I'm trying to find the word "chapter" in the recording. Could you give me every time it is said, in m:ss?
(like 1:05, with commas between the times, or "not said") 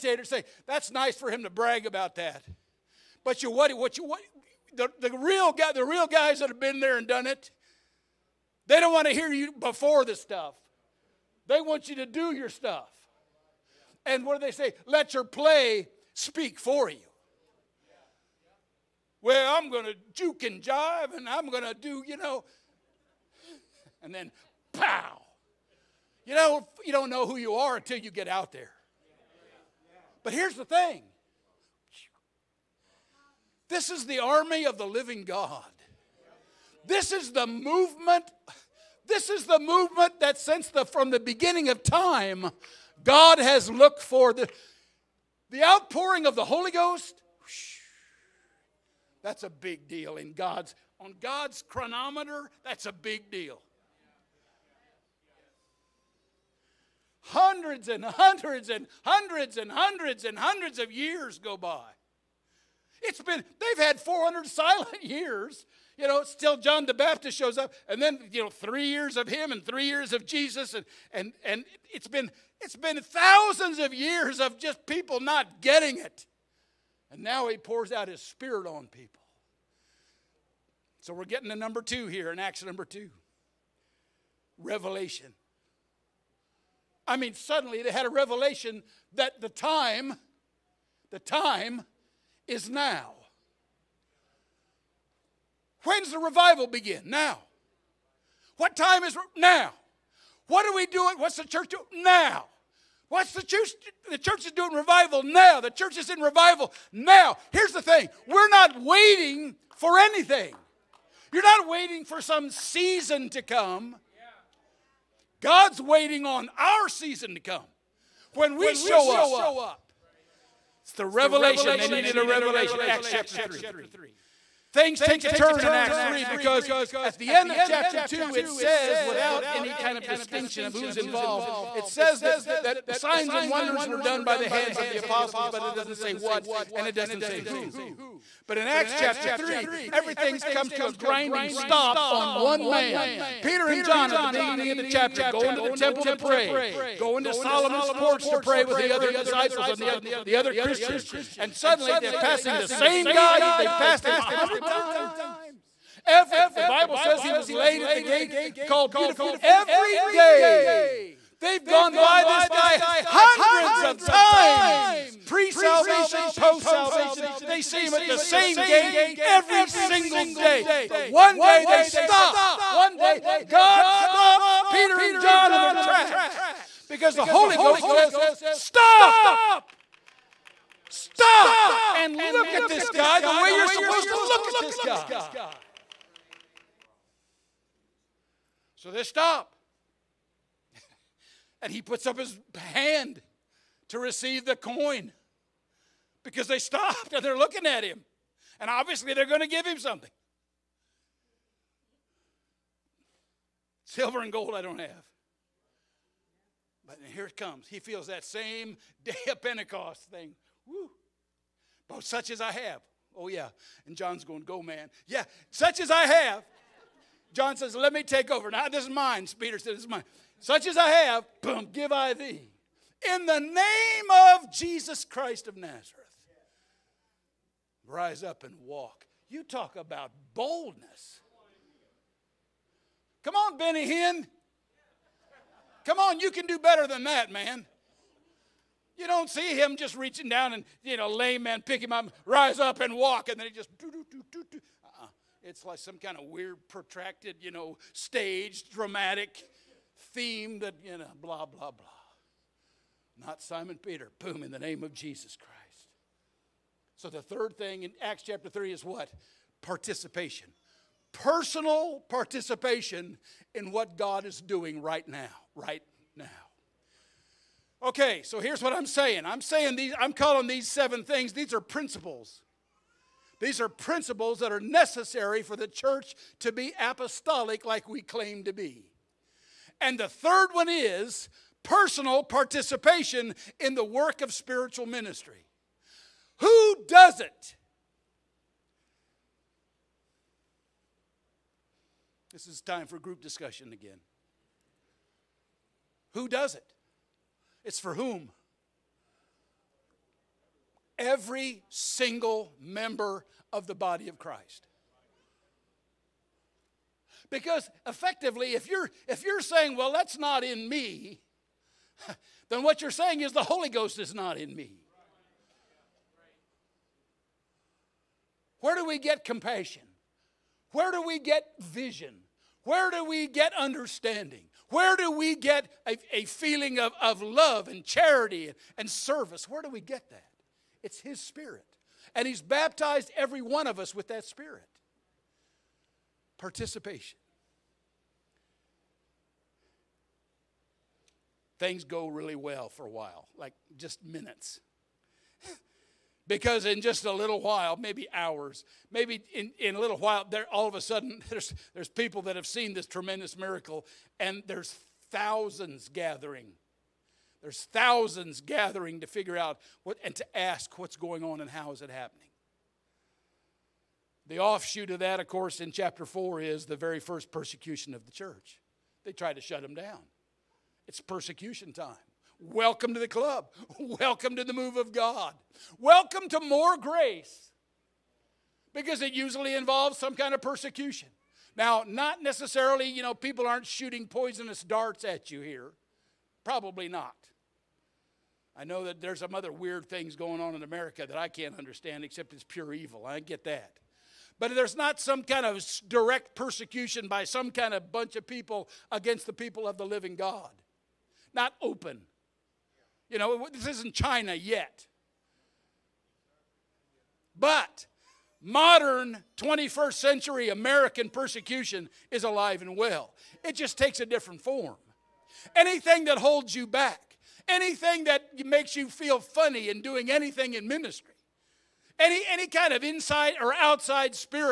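2:03, 2:07, 2:18, 2:24, 4:18, 6:05.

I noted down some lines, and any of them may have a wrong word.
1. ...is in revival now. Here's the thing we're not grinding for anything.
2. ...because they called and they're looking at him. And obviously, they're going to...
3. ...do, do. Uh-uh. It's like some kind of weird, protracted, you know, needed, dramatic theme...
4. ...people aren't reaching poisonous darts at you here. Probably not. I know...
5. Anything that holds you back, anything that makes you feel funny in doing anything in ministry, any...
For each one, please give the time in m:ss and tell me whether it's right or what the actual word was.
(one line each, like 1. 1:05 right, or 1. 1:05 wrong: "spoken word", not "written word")
1. 1:45 wrong: "waiting", not "grinding"
2. 3:16 wrong: "stopped", not "called"
3. 4:04 wrong: "staged", not "needed"
4. 6:23 wrong: "shooting", not "reaching"
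5. 6:55 right.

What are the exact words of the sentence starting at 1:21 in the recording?
So we're getting to number two here in Acts number two.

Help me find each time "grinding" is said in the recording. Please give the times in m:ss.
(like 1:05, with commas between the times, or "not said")
2:20.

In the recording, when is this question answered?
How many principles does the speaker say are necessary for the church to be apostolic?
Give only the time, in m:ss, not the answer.
4:30.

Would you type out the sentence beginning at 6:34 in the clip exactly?
But there's not some kind of direct persecution by some kind of bunch of people against the people of the living God.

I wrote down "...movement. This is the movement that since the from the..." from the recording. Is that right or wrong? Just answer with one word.
right.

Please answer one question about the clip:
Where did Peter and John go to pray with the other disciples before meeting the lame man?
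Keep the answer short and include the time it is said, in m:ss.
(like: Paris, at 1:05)
Solomon's porch, at 2:27.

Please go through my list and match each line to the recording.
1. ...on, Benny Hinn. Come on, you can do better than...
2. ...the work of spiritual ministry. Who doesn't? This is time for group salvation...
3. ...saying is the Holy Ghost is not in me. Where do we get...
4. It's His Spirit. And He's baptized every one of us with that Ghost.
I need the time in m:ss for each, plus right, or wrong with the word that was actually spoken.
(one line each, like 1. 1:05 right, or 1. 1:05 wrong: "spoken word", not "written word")
1. 3:53 right
2. 4:43 wrong: "discussion", not "salvation"
3. 5:12 right
4. 5:30 wrong: "Spirit", not "Ghost".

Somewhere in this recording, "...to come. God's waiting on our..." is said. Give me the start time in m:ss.
1:53.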